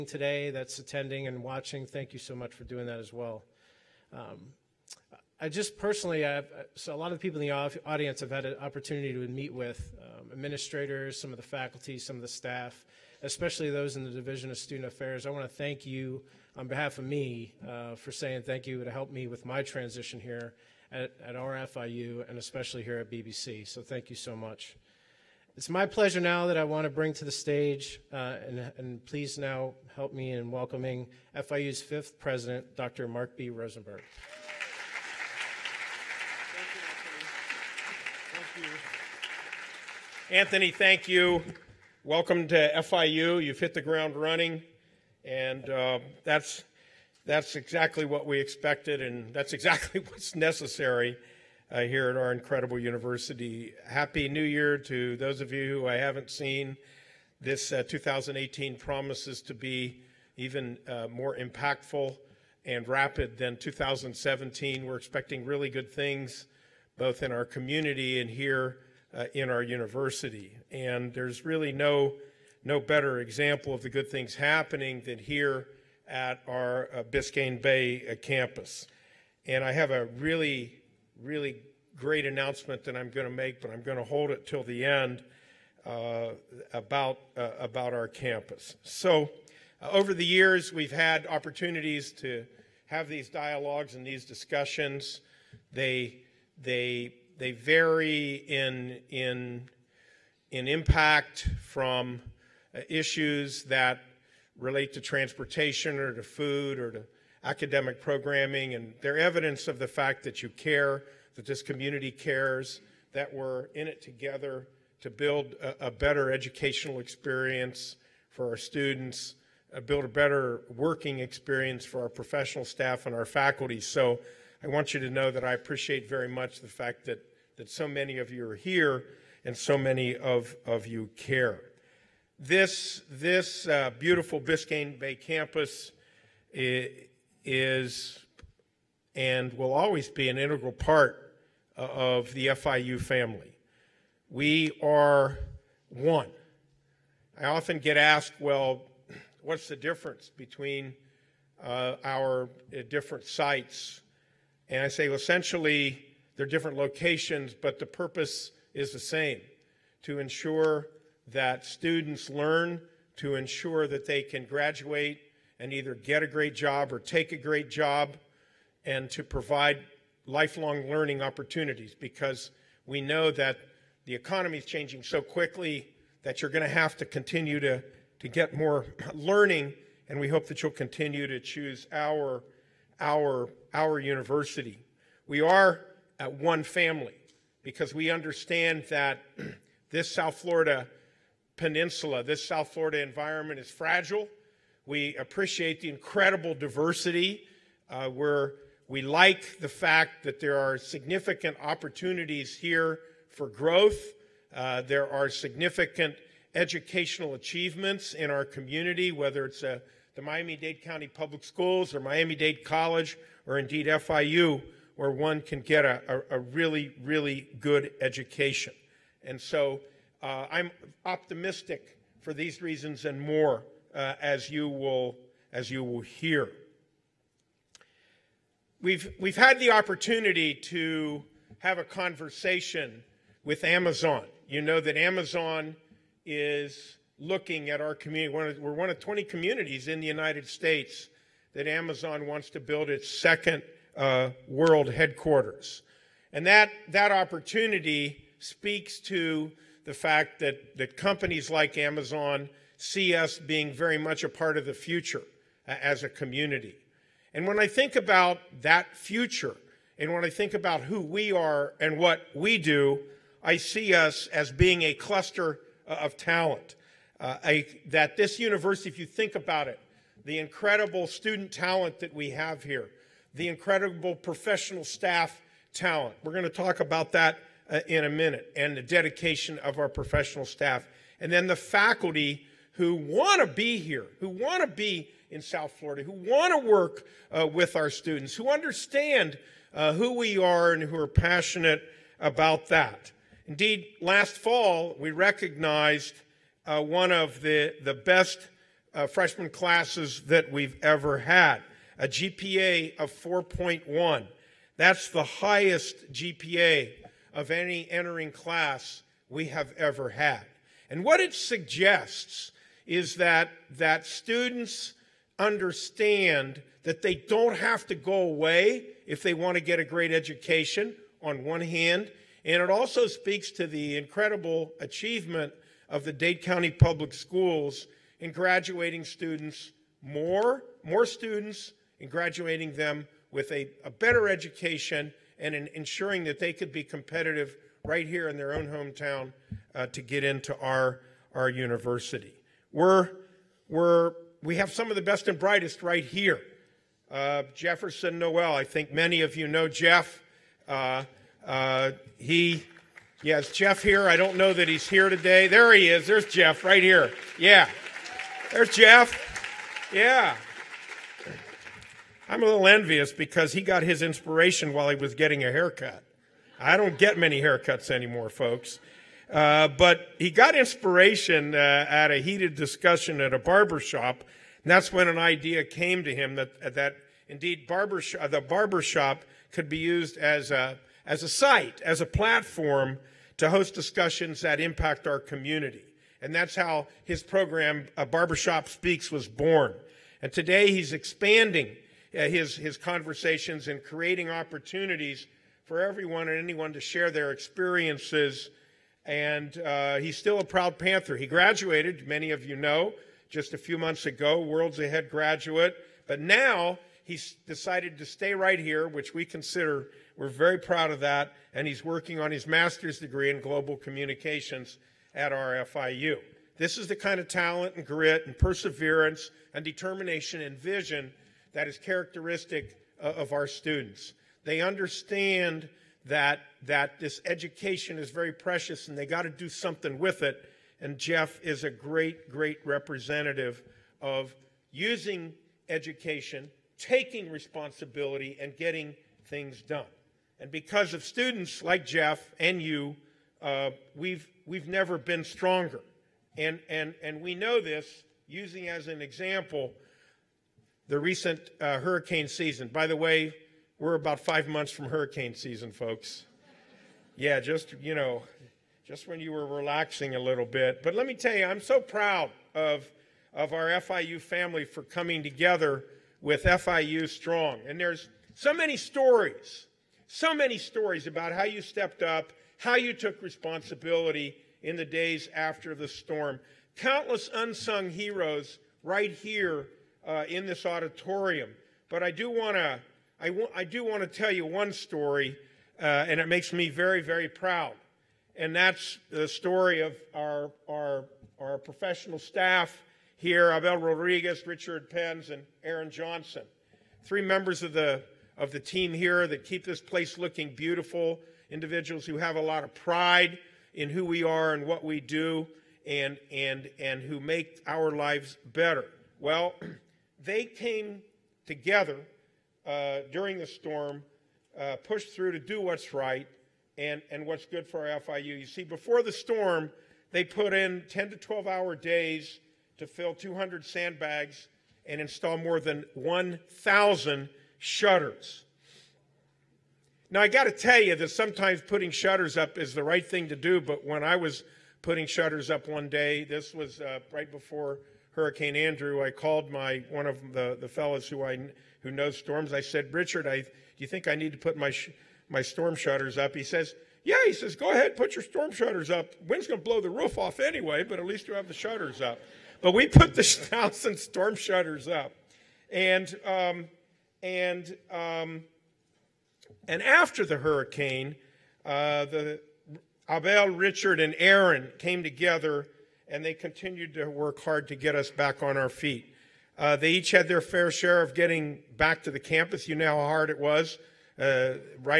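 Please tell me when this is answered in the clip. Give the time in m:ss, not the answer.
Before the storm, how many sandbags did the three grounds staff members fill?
8:43.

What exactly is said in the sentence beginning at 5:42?
We're, we're, we have some of the best and brightest right here.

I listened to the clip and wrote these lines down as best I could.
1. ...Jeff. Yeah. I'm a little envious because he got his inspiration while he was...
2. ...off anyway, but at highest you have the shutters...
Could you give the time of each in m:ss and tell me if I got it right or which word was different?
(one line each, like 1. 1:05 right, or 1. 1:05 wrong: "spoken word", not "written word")
1. 5:58 right
2. 9:10 wrong: "least", not "highest".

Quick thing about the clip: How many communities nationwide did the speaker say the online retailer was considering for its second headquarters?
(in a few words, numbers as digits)
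20.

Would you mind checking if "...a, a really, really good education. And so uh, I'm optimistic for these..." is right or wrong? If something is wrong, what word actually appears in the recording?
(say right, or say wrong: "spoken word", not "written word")
right.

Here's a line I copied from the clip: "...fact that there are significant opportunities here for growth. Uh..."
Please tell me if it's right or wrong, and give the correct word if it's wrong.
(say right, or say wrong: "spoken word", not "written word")
right.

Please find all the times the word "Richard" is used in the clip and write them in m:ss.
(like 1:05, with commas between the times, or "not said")
8:14, 9:02, 9:23.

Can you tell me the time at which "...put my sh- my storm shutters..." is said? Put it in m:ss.
9:04.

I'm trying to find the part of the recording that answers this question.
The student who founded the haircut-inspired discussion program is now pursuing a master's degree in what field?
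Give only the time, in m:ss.
6:53.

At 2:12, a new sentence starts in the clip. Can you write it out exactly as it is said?
This, this uh, beautiful Biscayne Bay campus eh, is and will always be an integral part uh, of the FIU family.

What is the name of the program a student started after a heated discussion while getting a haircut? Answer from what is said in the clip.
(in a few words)
Barbershop Speaks.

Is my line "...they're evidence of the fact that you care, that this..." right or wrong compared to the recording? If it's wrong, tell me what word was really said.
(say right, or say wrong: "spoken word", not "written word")
right.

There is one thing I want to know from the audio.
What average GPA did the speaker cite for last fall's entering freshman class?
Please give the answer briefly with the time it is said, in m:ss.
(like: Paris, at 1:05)
4.1, at 5:03.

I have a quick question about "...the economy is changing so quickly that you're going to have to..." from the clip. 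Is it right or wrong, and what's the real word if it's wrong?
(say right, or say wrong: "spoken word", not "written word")
right.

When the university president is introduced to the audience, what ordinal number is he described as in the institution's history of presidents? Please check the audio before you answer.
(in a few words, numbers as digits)
fifth.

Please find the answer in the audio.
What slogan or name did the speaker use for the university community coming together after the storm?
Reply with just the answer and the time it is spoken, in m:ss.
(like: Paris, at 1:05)
FIU Strong, at 7:46.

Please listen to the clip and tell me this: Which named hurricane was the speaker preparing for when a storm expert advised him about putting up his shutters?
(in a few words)
Hurricane Andrew.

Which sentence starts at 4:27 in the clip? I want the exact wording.
Uh, that this university, if you think about it, the incredible student talent that we have here, the incredible professional staff talent.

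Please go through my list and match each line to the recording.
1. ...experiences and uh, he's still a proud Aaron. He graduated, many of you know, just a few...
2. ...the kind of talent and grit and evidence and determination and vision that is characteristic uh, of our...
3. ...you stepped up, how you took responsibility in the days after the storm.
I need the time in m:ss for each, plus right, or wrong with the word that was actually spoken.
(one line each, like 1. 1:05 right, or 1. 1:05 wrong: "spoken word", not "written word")
1. 6:37 wrong: "Panther", not "Aaron"
2. 6:56 wrong: "perseverance", not "evidence"
3. 7:51 right.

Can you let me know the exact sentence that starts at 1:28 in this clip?
So, uh, over the years, we've had opportunities to have these dialogues and these discussions.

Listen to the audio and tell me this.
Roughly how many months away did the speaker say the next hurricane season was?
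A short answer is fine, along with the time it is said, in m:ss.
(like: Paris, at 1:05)
5, at 7:34.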